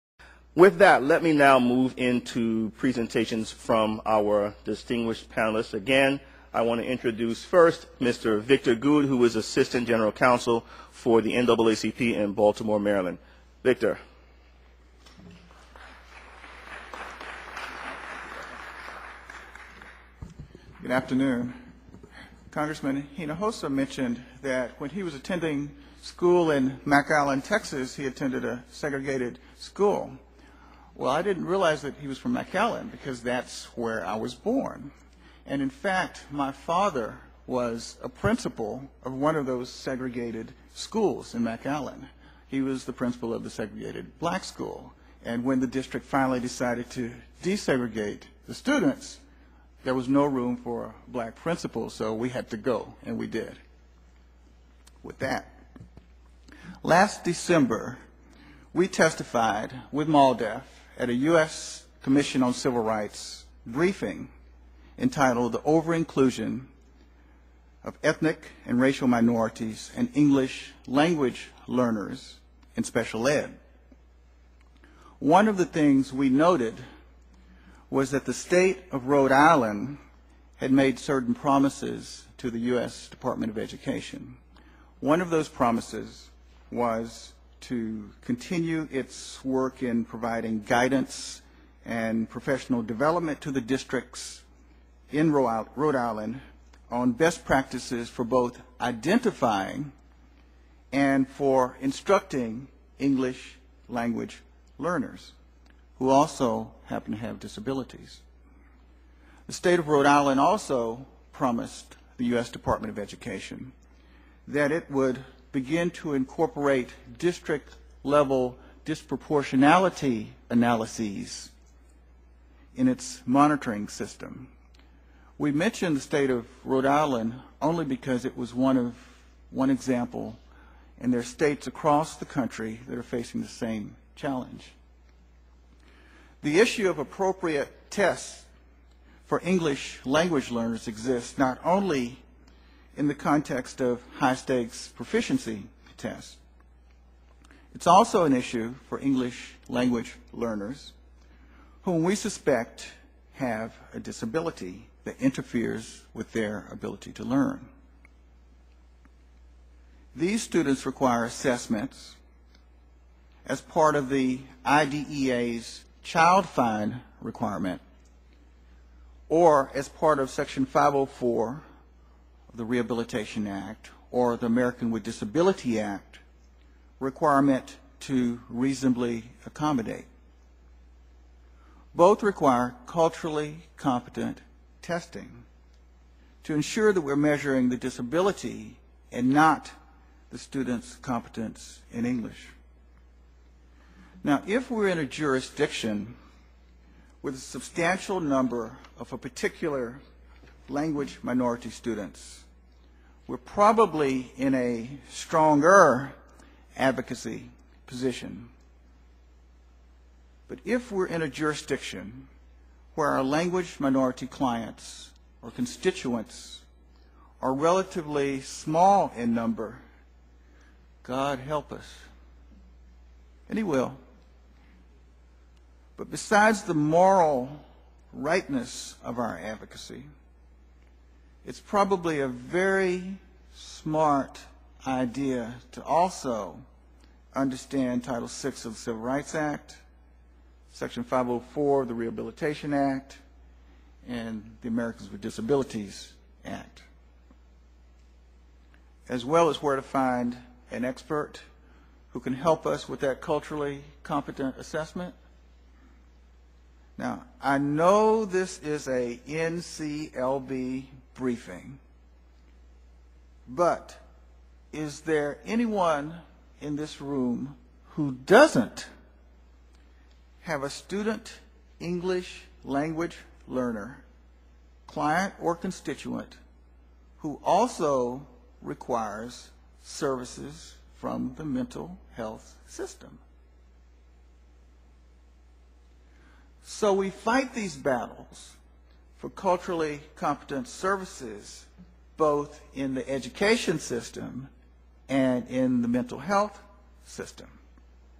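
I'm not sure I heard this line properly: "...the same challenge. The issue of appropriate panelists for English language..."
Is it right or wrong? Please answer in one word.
wrong.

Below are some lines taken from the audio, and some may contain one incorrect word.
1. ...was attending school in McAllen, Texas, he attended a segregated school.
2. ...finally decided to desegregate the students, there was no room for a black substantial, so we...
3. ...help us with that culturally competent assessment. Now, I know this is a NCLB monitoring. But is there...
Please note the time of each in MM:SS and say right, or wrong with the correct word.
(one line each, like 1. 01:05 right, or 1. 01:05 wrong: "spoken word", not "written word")
1. 00:25 right
2. 00:46 wrong: "principal", not "substantial"
3. 04:12 wrong: "briefing", not "monitoring".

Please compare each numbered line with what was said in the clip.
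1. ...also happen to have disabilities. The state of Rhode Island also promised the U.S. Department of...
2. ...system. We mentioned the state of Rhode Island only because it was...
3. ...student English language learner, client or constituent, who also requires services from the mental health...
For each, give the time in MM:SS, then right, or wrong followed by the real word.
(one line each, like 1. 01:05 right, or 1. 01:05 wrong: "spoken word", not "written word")
1. 01:46 right
2. 02:03 right
3. 04:30 right.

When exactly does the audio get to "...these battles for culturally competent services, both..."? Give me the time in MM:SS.
04:47.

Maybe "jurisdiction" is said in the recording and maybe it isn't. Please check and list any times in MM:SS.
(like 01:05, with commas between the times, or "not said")
03:15, 03:31.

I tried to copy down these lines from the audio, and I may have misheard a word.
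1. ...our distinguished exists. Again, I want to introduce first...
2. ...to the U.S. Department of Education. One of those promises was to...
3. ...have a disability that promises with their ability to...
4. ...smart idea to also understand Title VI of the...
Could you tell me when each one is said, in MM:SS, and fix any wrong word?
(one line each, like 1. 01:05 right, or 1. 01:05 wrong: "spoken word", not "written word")
1. 00:04 wrong: "panelists", not "exists"
2. 01:22 right
3. 02:33 wrong: "interferes", not "promises"
4. 03:53 right.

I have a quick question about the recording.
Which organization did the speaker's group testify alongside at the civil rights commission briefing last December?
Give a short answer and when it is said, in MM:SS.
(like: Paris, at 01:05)
MALDEF, at 01:00.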